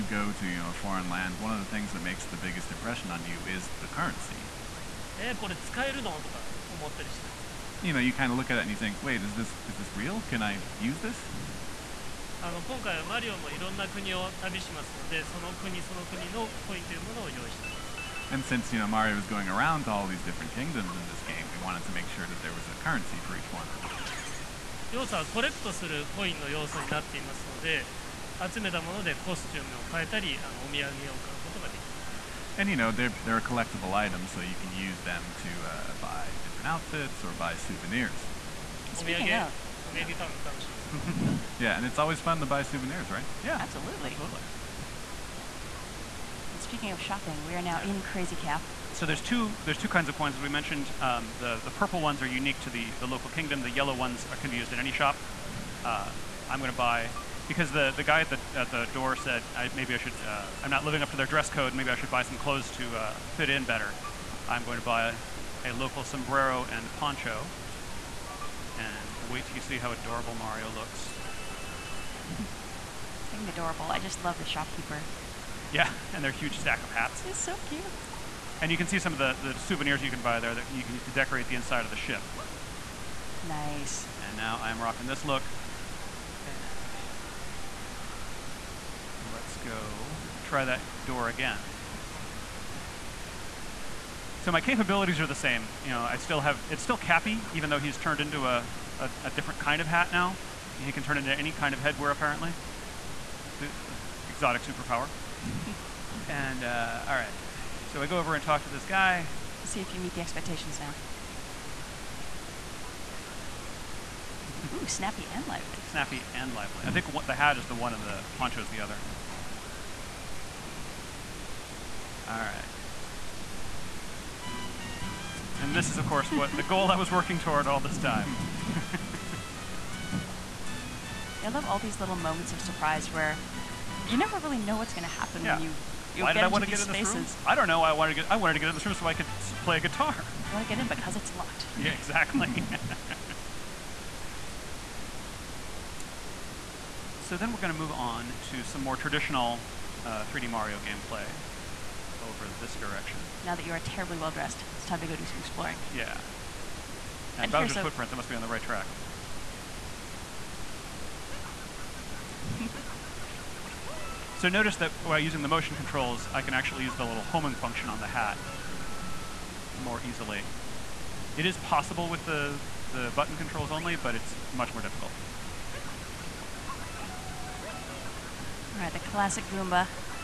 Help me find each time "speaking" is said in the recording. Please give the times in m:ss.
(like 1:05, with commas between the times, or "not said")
0:38, 0:46.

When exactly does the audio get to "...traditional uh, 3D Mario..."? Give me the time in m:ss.
2:28.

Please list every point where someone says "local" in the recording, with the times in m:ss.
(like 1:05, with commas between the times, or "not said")
0:53, 1:05.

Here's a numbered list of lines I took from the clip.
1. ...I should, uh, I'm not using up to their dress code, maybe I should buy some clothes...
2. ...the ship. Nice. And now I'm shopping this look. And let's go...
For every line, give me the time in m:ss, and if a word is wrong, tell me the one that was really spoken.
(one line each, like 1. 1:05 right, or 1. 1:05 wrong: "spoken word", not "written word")
1. 0:59 wrong: "living", not "using"
2. 1:21 wrong: "rocking", not "shopping".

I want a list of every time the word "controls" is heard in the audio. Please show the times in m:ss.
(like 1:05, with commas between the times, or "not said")
2:45, 2:53.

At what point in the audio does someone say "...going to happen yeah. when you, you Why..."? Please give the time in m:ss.
2:14.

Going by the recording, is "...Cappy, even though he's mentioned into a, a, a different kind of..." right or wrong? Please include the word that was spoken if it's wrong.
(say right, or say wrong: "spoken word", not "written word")
wrong: "turned", not "mentioned".